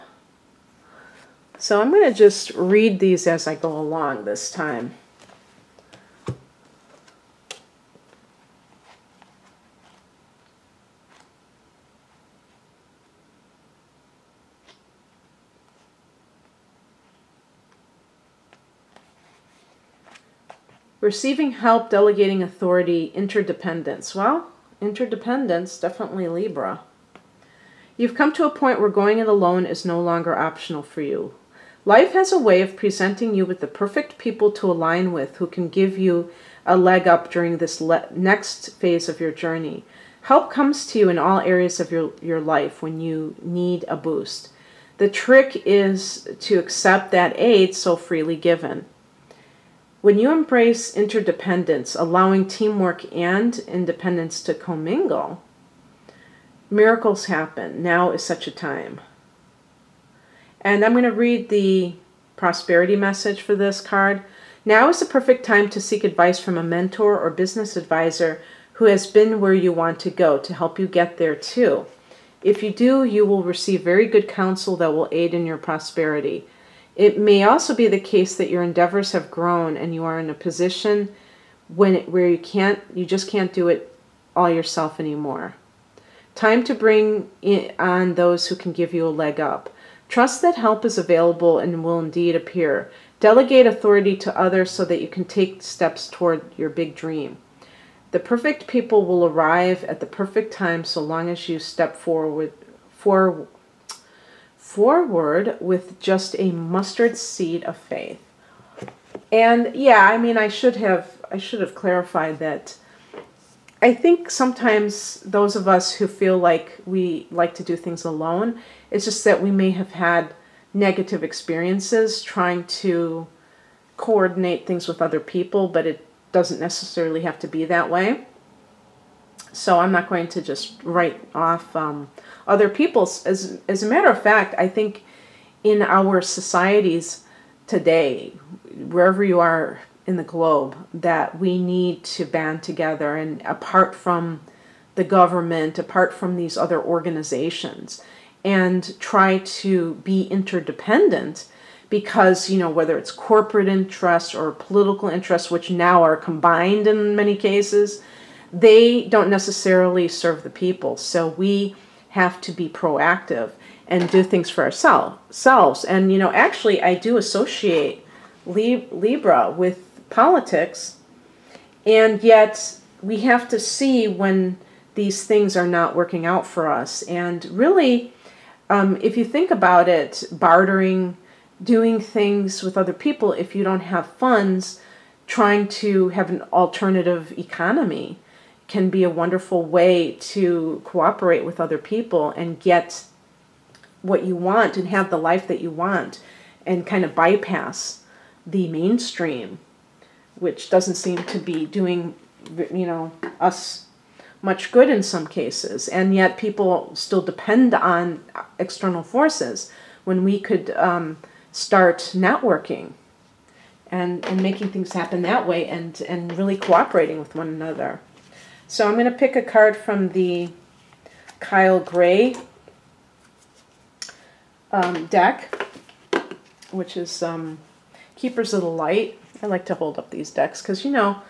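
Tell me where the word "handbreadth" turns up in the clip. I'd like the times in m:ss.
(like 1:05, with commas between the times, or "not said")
not said.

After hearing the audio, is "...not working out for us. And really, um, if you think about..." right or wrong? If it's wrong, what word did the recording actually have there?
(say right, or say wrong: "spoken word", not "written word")
right.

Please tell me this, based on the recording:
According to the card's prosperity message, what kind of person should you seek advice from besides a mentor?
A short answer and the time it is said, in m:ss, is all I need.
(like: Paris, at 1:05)
business advisor, at 1:07.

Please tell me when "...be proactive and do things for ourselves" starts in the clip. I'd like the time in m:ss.
2:42.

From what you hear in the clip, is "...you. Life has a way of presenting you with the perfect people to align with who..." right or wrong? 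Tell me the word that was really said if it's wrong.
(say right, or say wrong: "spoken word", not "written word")
right.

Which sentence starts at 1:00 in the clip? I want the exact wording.
And I'm going to read the prosperity message for this card.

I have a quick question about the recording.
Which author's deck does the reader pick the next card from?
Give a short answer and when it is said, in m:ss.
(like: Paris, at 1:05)
Kyle Gray, at 3:41.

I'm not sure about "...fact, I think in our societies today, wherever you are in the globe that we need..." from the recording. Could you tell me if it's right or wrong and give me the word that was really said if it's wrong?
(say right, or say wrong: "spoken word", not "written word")
right.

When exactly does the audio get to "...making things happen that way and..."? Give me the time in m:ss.
3:34.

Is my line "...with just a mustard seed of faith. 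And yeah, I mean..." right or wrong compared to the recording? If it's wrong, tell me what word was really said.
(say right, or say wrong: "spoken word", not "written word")
right.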